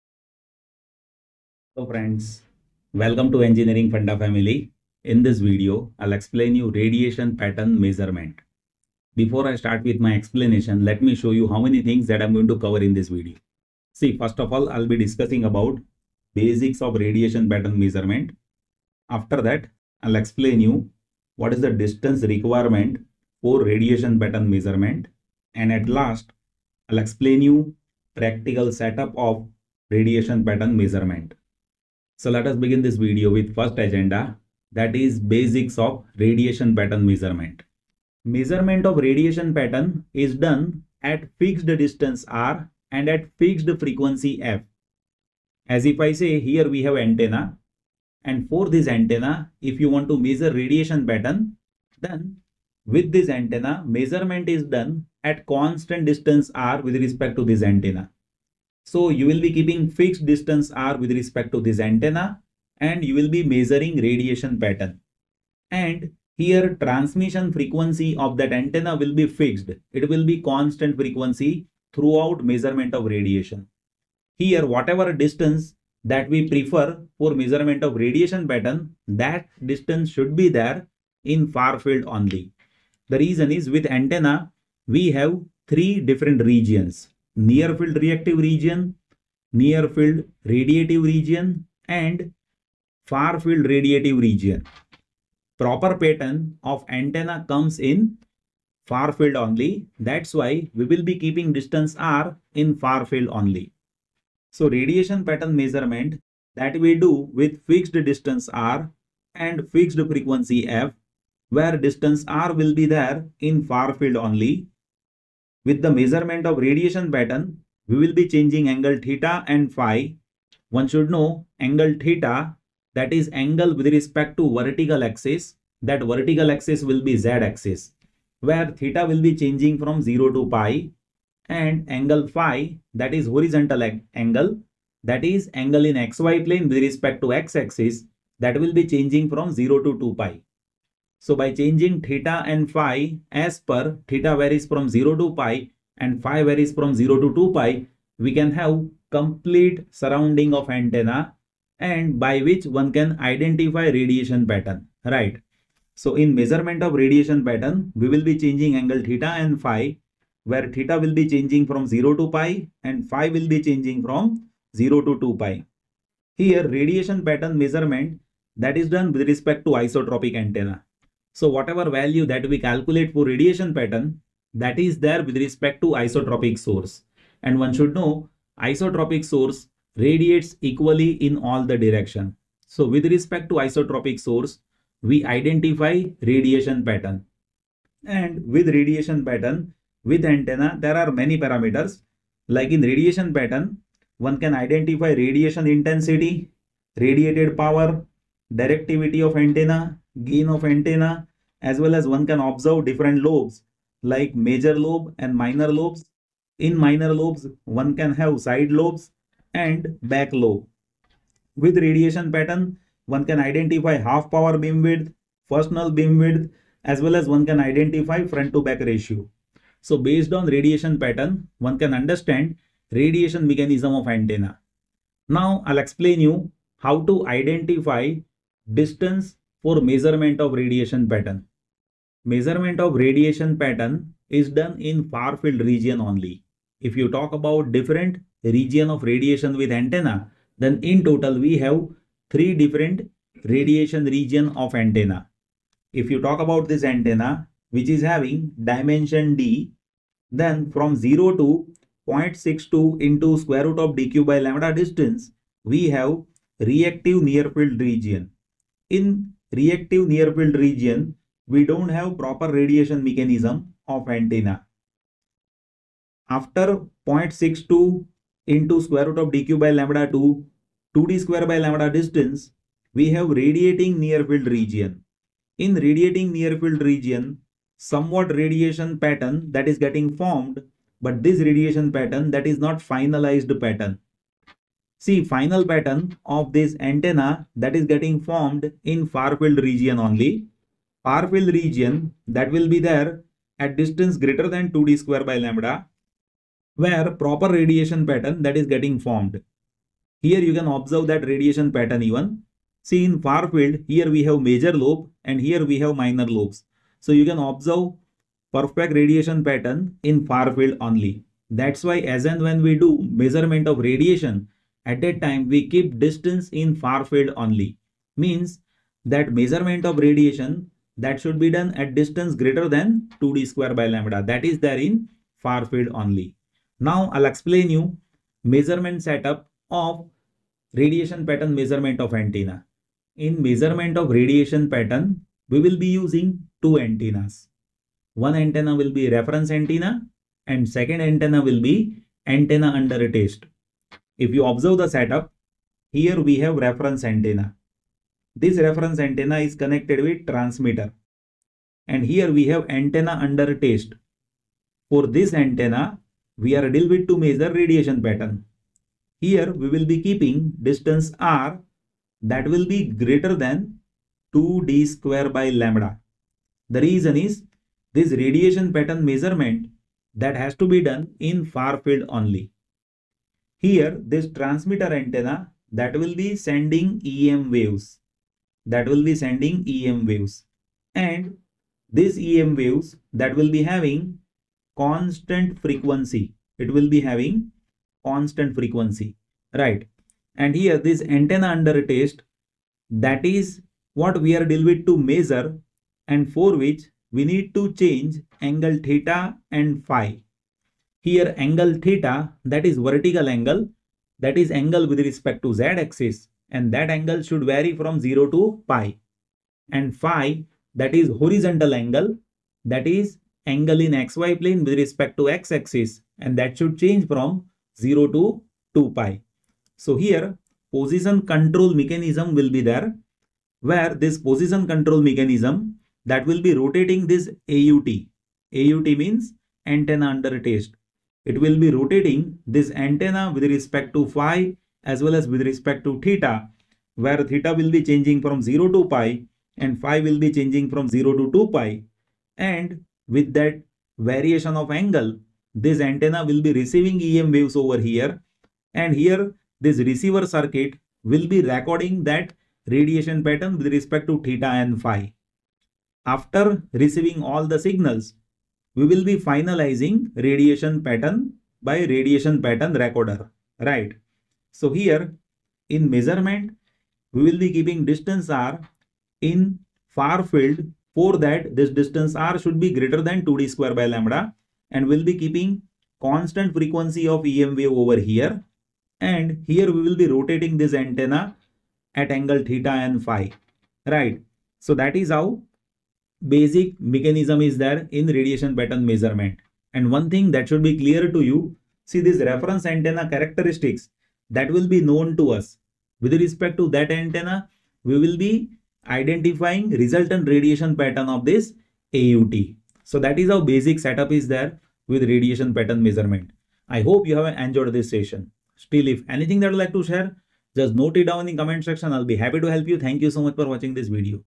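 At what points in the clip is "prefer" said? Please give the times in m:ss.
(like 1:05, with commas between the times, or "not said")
1:16.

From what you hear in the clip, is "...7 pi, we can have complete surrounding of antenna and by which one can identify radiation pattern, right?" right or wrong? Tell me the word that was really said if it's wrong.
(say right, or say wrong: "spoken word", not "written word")
wrong: "2", not "7".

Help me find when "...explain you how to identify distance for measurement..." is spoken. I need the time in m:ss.
3:45.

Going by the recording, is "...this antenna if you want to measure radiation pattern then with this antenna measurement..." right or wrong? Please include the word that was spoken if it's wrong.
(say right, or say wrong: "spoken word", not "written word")
right.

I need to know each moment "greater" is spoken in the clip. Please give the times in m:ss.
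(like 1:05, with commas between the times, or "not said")
4:54, 5:22, 6:03, 7:52.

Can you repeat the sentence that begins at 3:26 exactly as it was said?
In minor lobes, one can have side lobes and back lobe.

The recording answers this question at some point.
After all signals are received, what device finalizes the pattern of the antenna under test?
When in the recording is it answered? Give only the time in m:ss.
7:41.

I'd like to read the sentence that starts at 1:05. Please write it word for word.
And here transmission frequency of that antenna will be fixed.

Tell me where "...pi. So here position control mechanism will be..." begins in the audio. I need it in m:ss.
6:58.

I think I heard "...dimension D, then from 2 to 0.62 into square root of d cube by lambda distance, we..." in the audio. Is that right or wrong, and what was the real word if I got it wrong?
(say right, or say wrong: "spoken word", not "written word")
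wrong: "0", not "2".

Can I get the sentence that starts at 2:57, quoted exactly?
And one should know isotropic source radiates equally in all the direction.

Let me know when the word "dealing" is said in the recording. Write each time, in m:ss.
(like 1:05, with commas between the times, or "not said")
5:56, 6:34.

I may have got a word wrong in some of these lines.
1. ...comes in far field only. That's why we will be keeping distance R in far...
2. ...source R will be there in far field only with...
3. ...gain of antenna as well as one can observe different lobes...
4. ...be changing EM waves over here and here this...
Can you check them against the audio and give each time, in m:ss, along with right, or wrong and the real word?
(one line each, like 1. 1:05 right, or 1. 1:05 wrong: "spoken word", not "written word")
1. 1:37 right
2. 1:51 wrong: "distance", not "source"
3. 3:20 right
4. 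7:26 wrong: "receiving", not "changing".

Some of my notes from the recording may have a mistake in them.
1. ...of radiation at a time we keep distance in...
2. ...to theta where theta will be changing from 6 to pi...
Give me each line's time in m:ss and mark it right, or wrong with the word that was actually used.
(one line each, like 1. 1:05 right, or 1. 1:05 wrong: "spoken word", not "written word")
1. 5:13 right
2. 7:15 wrong: "0", not "6".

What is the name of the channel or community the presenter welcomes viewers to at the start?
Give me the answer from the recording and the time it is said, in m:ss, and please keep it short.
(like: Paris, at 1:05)
Engineering Funda, at 0:03.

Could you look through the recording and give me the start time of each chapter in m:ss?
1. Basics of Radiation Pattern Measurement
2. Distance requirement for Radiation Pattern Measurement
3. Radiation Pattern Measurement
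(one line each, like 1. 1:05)
1. 0:38
2. 3:52
3. 5:33.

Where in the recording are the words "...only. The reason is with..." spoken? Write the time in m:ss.
1:22.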